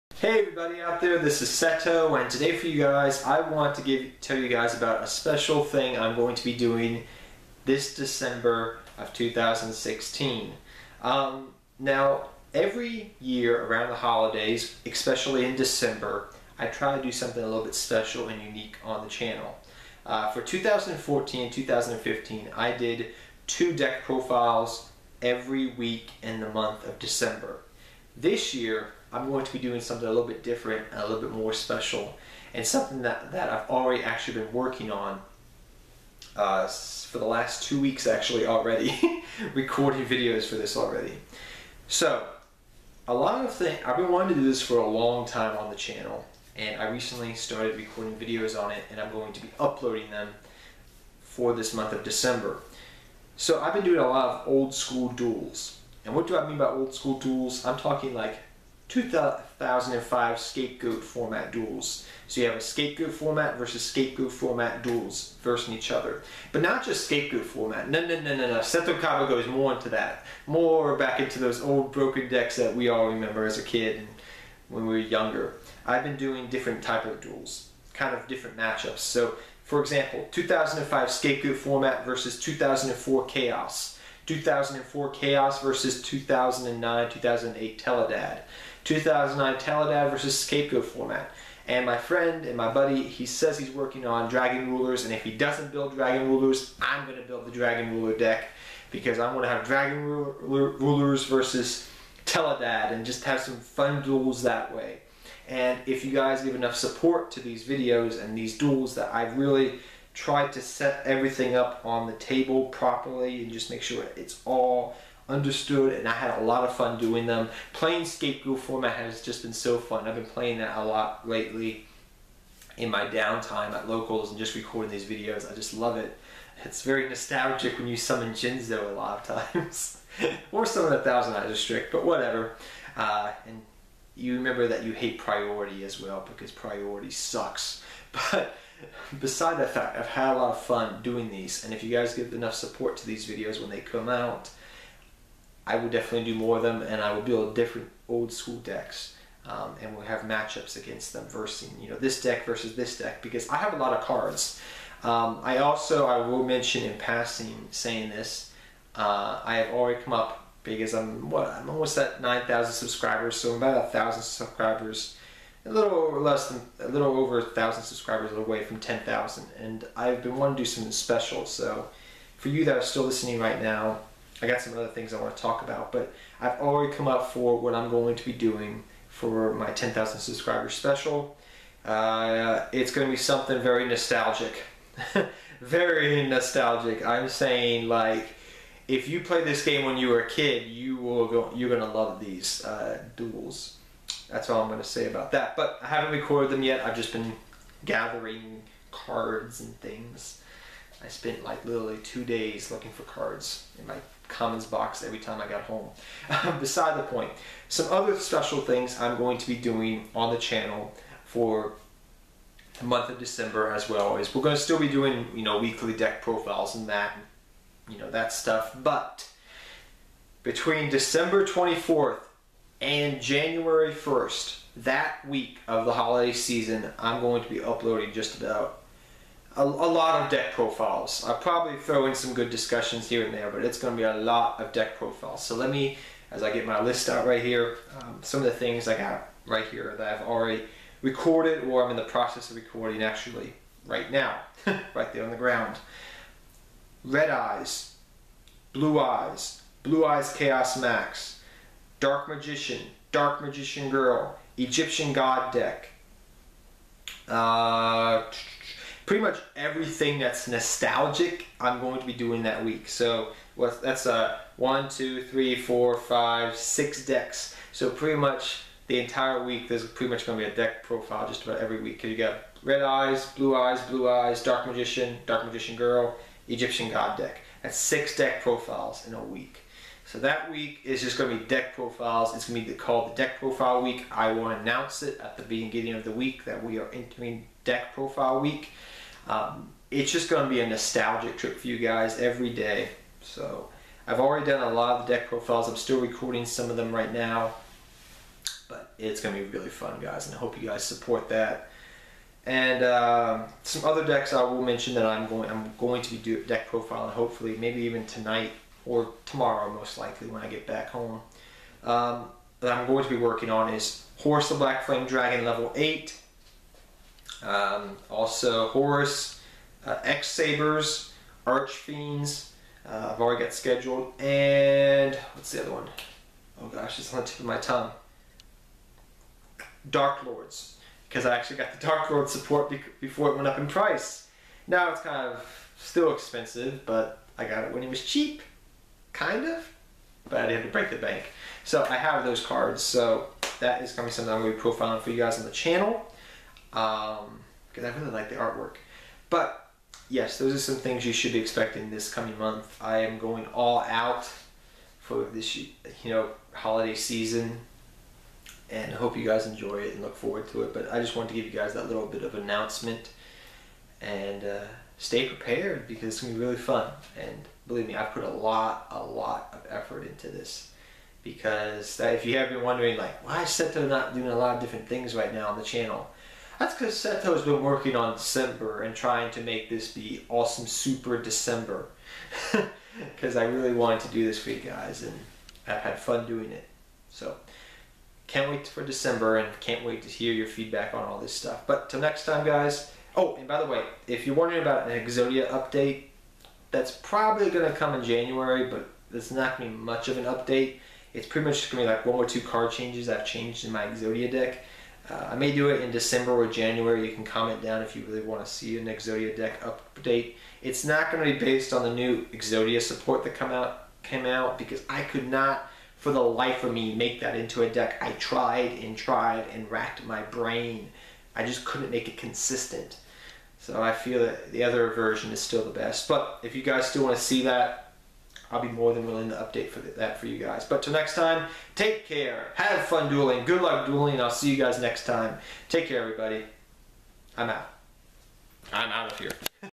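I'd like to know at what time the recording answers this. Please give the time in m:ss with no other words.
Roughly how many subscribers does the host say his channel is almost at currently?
2:42.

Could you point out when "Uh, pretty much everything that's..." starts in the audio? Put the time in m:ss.
4:17.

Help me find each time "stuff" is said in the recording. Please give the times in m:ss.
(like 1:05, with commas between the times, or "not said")
3:38, 6:31.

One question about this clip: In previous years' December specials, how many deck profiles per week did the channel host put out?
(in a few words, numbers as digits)
2.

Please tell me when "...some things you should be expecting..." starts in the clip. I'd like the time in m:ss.
5:50.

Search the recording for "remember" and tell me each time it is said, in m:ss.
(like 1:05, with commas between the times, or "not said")
1:13, 2:14.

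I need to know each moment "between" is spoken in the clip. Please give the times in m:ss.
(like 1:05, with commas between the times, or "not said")
3:40.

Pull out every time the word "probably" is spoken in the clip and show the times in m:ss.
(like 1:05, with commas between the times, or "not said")
3:51, 6:36.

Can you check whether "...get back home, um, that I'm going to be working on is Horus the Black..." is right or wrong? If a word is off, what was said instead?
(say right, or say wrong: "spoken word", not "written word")
right.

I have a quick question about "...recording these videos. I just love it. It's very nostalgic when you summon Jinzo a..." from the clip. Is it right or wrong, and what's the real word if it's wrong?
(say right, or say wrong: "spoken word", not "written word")
right.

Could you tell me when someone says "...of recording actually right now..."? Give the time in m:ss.
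4:02.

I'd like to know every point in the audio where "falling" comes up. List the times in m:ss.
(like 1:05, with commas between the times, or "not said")
not said.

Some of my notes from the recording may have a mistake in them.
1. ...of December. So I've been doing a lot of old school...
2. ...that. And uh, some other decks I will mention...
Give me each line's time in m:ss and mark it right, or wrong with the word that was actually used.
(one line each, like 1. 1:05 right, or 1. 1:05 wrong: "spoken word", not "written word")
1. 0:51 right
2. 5:01 right.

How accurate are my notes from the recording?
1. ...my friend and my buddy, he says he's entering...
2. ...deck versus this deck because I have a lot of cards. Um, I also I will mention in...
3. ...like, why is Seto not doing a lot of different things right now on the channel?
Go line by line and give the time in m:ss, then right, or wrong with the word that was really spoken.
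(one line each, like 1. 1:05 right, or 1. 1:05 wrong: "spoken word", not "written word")
1. 1:31 wrong: "working", not "entering"
2. 2:32 right
3. 6:12 right.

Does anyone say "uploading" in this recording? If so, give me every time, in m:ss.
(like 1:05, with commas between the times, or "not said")
0:49, 3:47.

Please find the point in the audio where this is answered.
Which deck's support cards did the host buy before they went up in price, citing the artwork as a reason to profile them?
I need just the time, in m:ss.
5:29.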